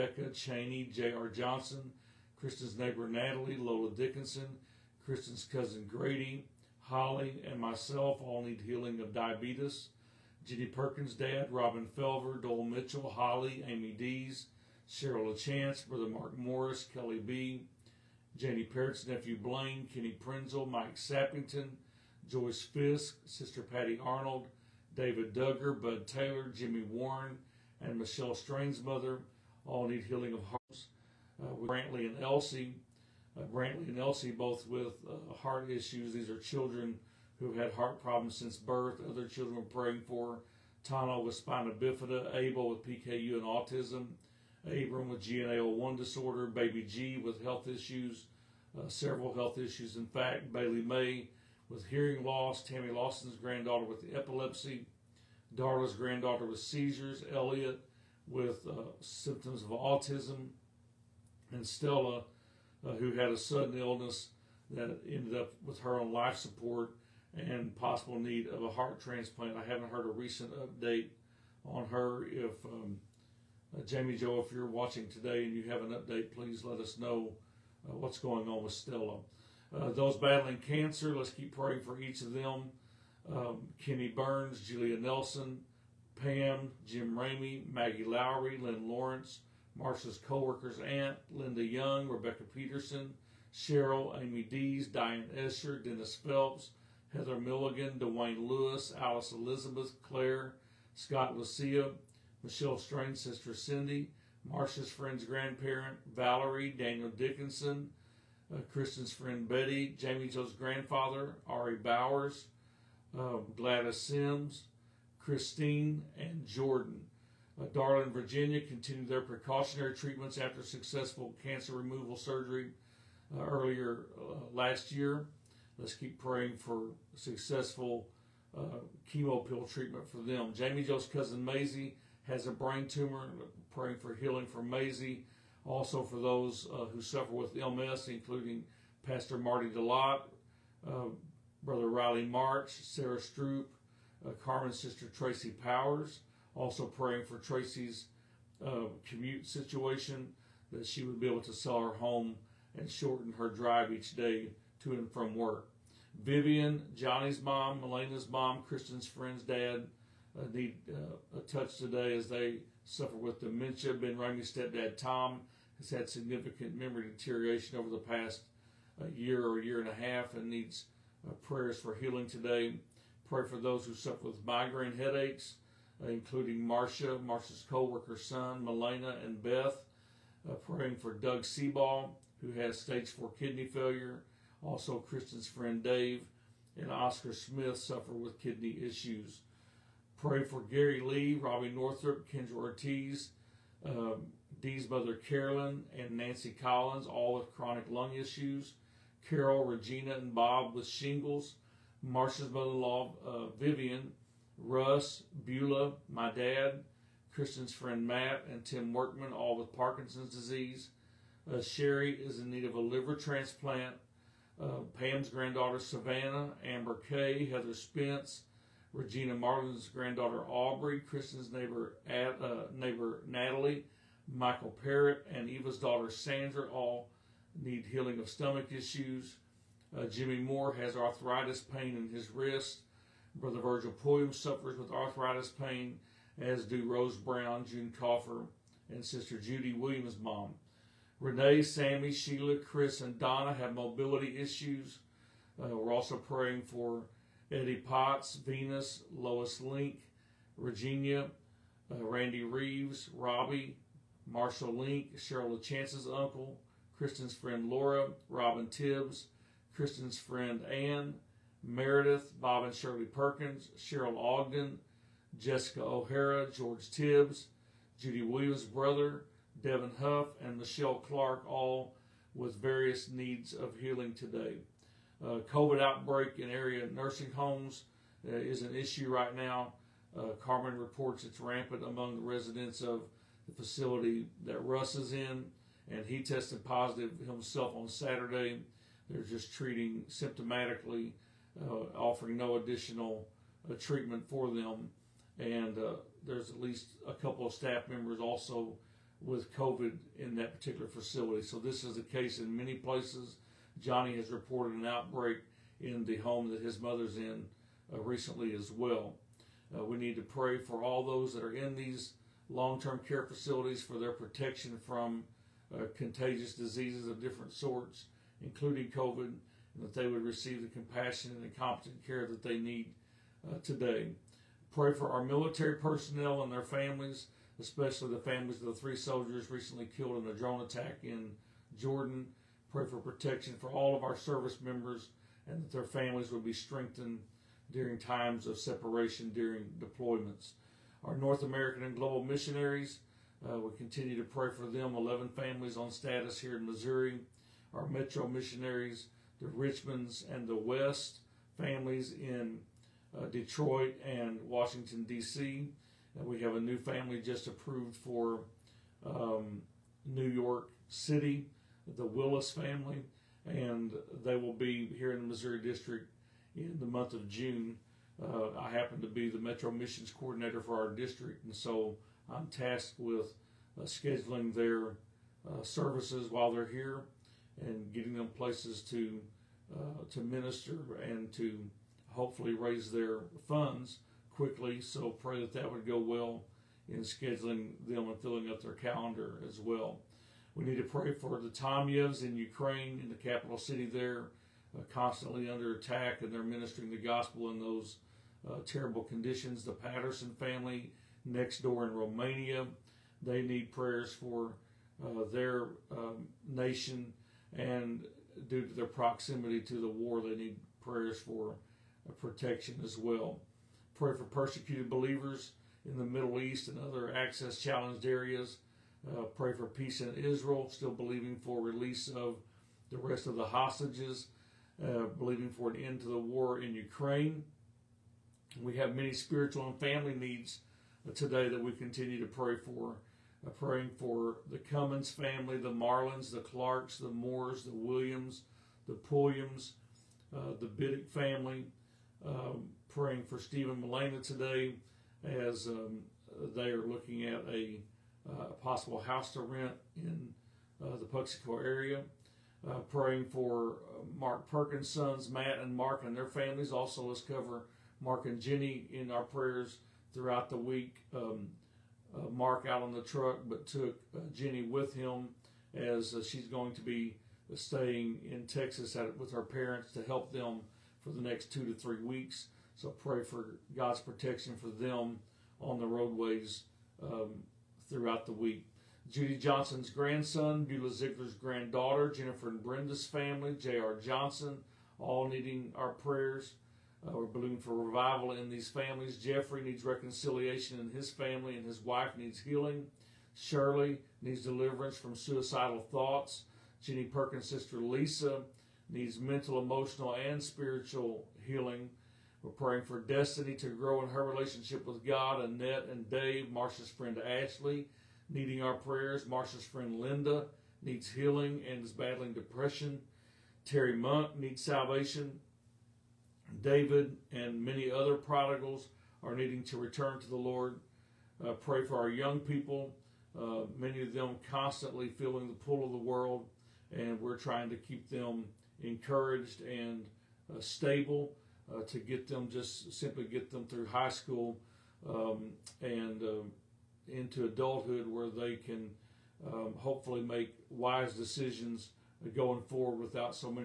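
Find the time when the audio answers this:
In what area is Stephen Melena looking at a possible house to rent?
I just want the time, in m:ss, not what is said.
7:31.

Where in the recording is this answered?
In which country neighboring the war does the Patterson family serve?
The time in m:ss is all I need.
6:41.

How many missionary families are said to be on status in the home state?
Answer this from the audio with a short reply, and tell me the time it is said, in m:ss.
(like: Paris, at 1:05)
11, at 5:44.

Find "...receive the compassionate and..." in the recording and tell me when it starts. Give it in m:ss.
5:20.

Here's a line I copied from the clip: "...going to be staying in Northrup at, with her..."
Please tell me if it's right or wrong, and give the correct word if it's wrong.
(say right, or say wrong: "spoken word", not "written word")
wrong: "Texas", not "Northrup".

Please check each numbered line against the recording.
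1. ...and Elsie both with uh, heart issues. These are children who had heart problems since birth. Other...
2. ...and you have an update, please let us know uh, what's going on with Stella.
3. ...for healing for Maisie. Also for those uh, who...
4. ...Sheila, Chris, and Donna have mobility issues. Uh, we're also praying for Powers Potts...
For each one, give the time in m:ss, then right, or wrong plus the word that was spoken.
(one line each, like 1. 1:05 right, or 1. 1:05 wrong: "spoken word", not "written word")
1. 0:33 right
2. 1:15 right
3. 2:13 right
4. 4:02 wrong: "Eddie", not "Powers".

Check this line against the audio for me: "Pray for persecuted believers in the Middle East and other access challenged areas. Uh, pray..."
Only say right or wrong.
right.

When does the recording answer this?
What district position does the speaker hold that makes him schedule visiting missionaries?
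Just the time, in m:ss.
6:09.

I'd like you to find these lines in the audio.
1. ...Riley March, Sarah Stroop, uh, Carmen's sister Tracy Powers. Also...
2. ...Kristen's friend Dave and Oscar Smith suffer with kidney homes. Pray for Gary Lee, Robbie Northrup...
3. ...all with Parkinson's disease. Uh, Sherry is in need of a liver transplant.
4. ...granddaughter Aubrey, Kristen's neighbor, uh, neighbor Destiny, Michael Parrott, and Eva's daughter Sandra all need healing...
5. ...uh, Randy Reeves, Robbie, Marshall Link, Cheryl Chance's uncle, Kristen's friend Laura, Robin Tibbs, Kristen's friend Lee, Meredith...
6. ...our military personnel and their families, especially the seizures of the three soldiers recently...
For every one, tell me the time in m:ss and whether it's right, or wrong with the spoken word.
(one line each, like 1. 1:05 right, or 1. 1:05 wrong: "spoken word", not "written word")
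1. 2:21 right
2. 3:04 wrong: "issues", not "homes"
3. 3:29 right
4. 3:39 wrong: "Natalie", not "Destiny"
5. 4:11 wrong: "Ann", not "Lee"
6. 5:25 wrong: "families", not "seizures".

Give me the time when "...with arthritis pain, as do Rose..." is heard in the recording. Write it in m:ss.
3:54.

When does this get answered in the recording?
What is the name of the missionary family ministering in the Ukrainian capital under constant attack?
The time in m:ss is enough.
6:31.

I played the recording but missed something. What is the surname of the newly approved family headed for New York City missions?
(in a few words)
Willis.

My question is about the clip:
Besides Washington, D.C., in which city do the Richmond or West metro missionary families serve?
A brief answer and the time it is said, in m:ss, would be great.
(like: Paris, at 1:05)
Detroit, at 5:53.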